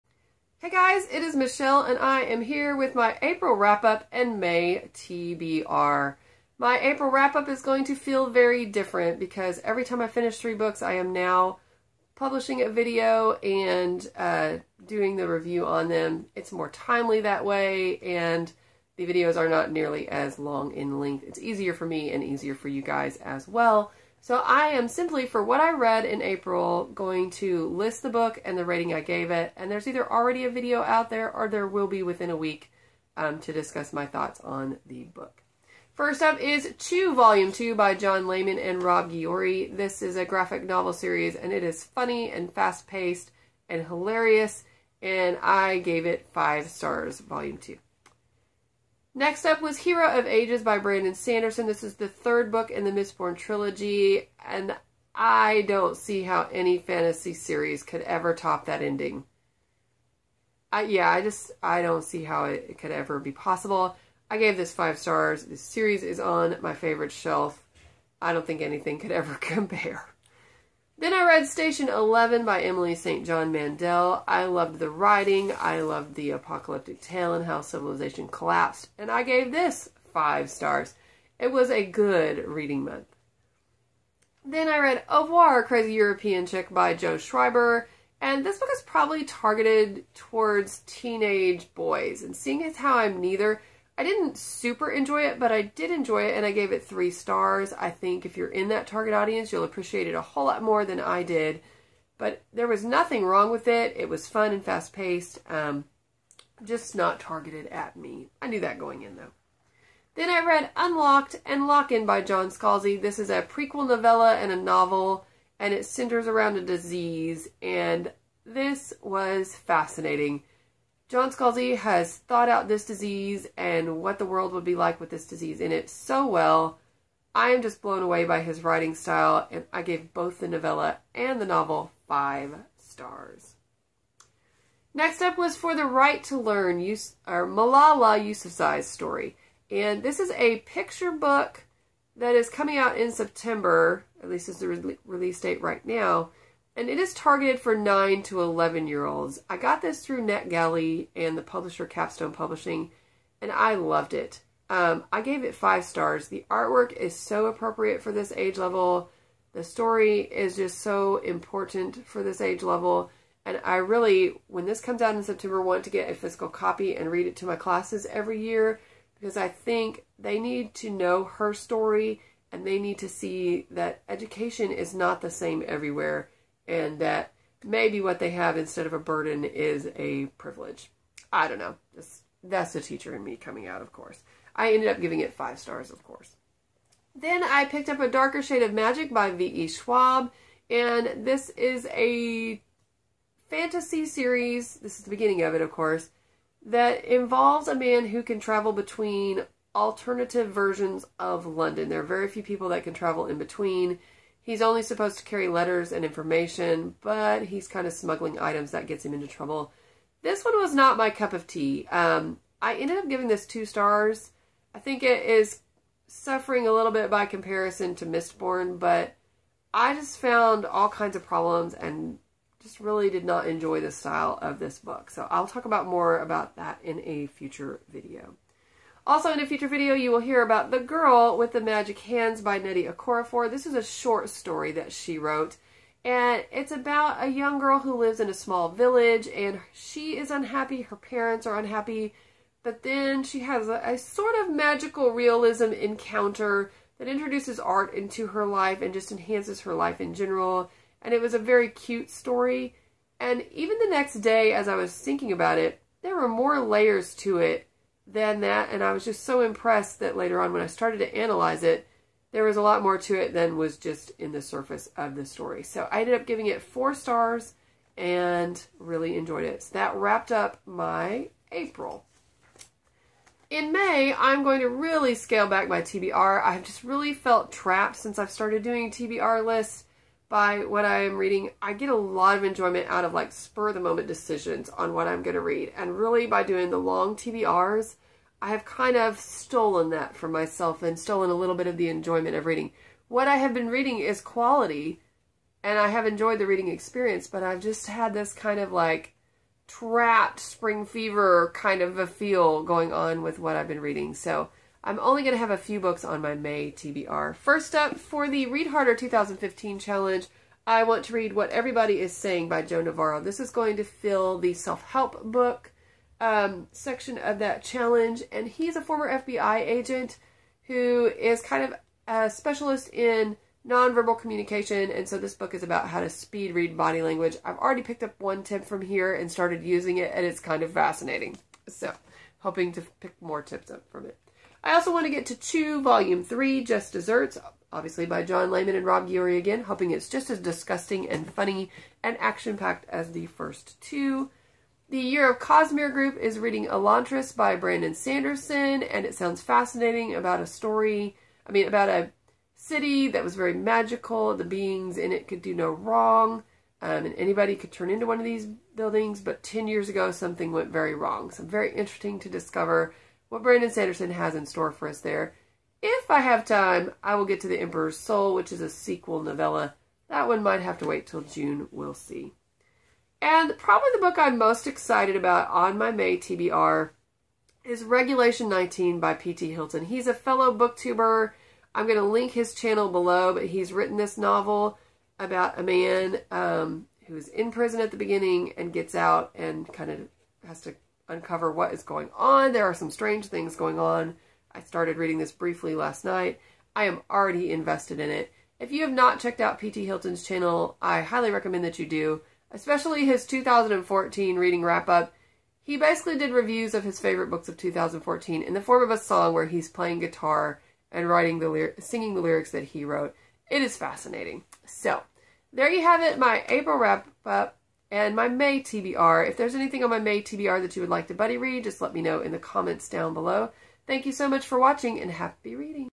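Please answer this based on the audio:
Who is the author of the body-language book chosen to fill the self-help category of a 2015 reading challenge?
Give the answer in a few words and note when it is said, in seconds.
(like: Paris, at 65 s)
Joe Navarro, at 312 s.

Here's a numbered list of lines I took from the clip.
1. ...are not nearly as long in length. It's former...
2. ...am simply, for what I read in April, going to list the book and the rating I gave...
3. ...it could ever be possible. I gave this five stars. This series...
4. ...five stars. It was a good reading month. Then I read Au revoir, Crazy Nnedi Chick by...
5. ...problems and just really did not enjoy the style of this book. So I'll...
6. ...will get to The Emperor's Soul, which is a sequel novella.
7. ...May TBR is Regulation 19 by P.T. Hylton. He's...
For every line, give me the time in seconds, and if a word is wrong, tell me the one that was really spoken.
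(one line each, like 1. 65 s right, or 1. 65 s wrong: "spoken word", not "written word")
1. 19 s wrong: "easier", not "former"
2. 24 s right
3. 62 s right
4. 80 s wrong: "European", not "Nnedi"
5. 221 s right
6. 367 s right
7. 375 s right.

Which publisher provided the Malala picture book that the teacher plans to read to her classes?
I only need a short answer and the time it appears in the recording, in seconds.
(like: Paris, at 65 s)
Capstone Publishing, at 151 s.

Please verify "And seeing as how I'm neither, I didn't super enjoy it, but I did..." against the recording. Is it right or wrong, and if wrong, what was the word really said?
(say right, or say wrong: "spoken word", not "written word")
right.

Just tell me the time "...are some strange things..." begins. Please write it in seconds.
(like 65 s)
392 s.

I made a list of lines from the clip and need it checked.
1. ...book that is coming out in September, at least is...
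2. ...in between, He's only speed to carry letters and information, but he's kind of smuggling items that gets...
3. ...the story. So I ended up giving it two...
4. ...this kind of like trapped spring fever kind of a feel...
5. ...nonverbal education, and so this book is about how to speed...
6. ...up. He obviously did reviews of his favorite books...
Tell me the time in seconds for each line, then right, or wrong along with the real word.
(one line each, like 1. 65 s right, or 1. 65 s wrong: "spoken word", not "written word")
1. 141 s right
2. 203 s wrong: "supposed", not "speed"
3. 265 s wrong: "four", not "two"
4. 298 s right
5. 323 s wrong: "communication", not "education"
6. 404 s wrong: "basically", not "obviously".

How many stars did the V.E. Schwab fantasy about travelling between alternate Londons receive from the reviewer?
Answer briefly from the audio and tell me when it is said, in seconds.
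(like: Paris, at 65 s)
2 stars, at 213 s.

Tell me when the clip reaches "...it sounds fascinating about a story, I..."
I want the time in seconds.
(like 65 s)
349 s.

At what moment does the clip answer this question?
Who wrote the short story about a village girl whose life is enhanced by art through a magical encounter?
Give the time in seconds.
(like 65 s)
232 s.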